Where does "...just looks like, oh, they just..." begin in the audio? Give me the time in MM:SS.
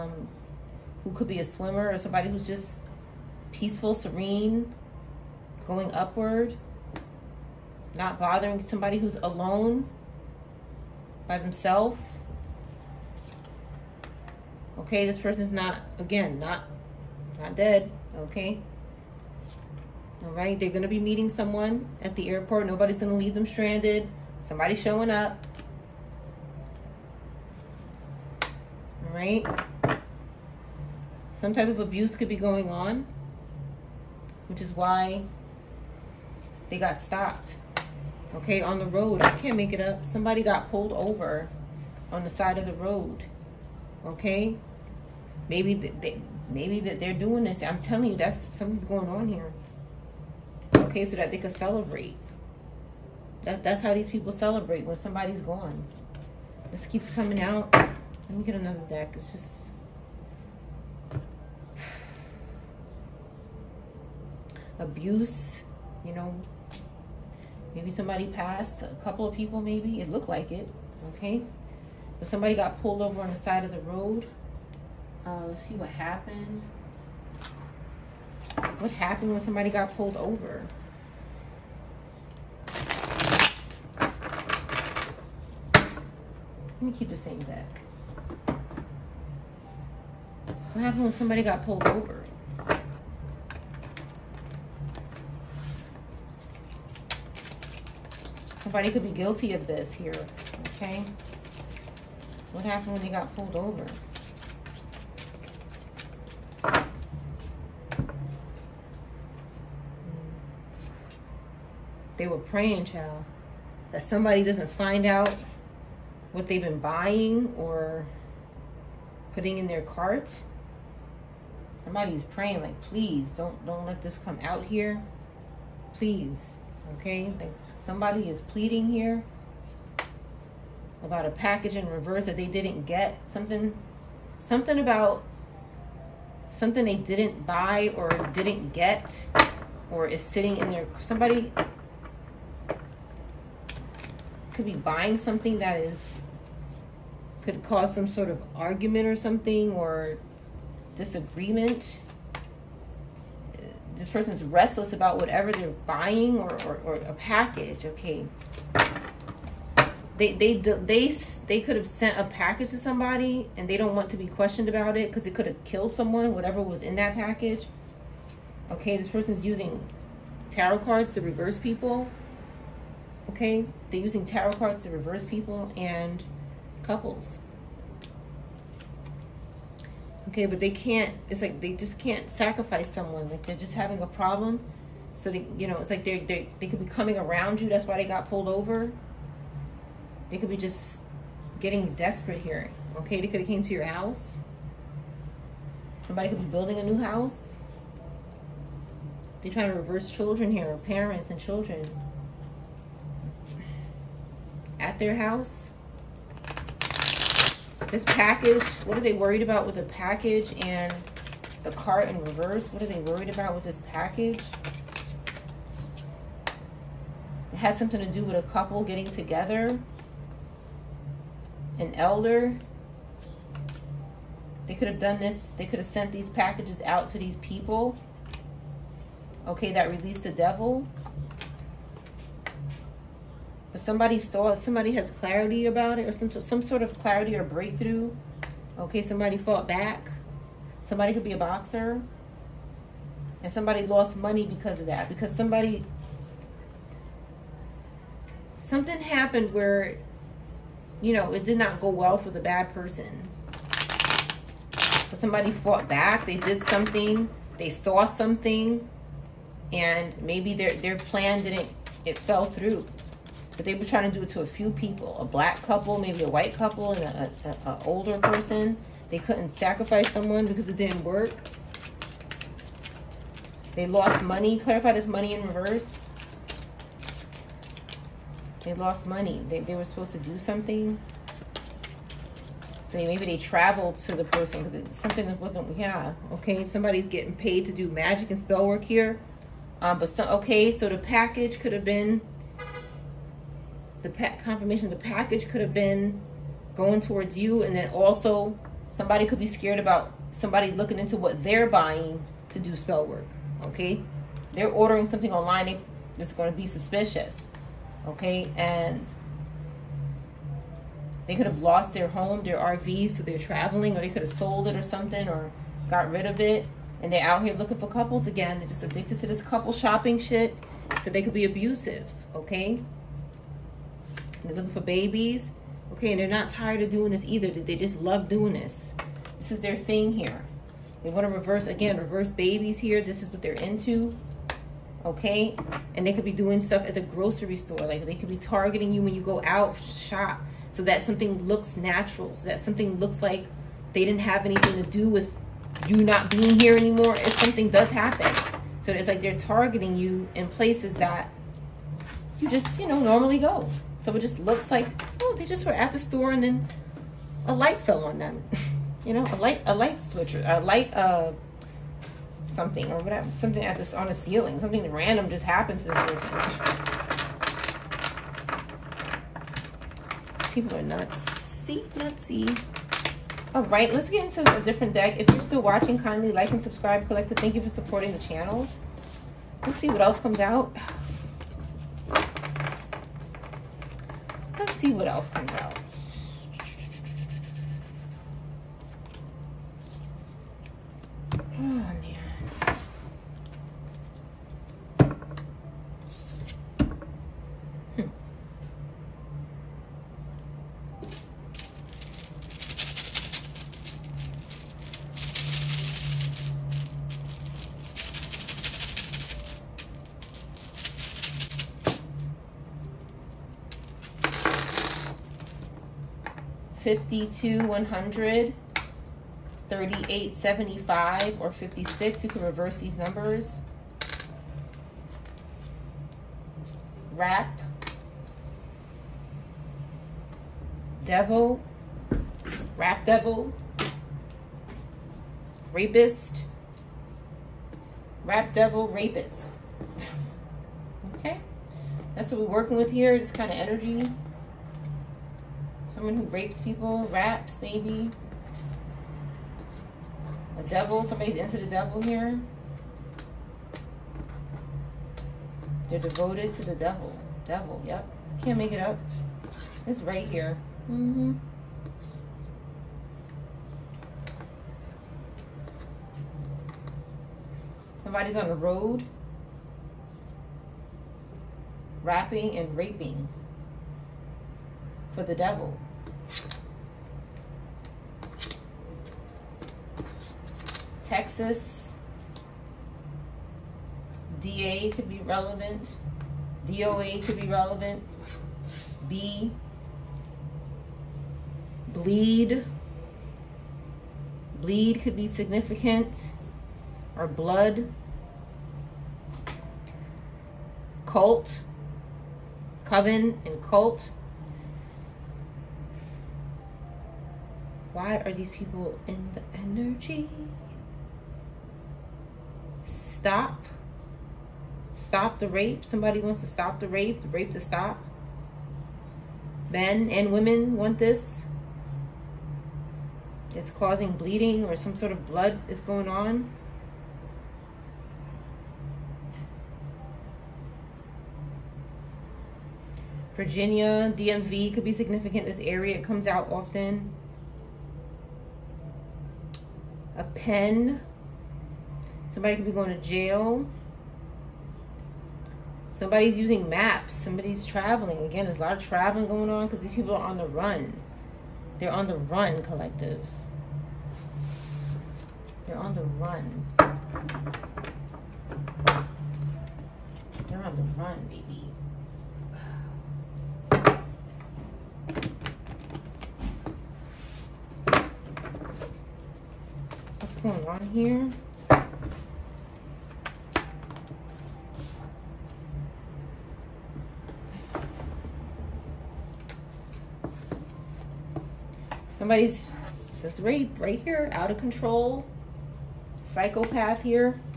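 05:54.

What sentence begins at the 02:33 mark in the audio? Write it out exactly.
This person's restless about whatever they're buying or, or, or a package, okay?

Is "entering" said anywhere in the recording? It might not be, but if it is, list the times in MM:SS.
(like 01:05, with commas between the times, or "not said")
not said.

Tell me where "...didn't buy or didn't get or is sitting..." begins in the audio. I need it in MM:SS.
02:16.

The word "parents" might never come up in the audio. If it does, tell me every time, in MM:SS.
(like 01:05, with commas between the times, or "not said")
03:20.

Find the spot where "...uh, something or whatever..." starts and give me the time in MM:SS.
06:00.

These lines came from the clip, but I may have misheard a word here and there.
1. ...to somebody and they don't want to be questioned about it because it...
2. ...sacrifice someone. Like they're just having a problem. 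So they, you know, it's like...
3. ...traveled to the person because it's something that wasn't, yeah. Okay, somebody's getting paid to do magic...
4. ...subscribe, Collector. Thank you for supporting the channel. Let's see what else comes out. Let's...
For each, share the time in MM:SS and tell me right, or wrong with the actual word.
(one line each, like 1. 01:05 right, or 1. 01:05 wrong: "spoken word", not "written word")
1. 02:42 right
2. 03:02 right
3. 04:43 right
4. 06:16 right.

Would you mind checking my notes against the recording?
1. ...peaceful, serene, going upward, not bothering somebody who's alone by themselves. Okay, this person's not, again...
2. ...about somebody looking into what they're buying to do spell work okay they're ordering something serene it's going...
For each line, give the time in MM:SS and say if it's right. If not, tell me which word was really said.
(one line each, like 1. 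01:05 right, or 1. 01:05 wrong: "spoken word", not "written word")
1. 00:03 right
2. 04:59 wrong: "online", not "serene".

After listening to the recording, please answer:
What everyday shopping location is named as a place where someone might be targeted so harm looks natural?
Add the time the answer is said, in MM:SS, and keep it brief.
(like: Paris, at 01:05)
grocery store, at 05:36.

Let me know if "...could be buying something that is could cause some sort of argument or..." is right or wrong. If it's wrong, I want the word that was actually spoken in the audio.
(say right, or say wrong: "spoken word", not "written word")
right.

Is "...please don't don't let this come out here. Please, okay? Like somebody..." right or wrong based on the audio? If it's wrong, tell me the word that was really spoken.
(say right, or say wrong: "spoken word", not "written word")
right.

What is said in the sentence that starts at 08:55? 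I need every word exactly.
This area it comes out often.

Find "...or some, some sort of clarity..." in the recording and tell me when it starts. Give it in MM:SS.
03:56.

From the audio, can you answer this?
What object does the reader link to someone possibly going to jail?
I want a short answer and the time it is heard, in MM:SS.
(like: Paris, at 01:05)
a pen, at 09:00.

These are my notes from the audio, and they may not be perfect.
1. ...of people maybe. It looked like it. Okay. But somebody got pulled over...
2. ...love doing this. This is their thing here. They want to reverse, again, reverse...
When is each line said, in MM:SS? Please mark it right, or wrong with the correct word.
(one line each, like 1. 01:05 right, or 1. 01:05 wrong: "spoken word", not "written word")
1. 01:09 right
2. 05:28 right.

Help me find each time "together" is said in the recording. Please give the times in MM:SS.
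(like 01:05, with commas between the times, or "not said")
03:39.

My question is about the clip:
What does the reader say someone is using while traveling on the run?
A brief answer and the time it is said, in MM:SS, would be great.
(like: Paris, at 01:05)
maps, at 09:06.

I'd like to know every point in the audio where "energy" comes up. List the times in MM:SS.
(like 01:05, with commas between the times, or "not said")
07:23, 08:29.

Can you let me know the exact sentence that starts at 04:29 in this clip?
They couldn't sacrifice someone because it didn't work.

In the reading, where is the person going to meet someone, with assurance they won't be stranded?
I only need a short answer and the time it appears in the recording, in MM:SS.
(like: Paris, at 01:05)
the airport, at 00:22.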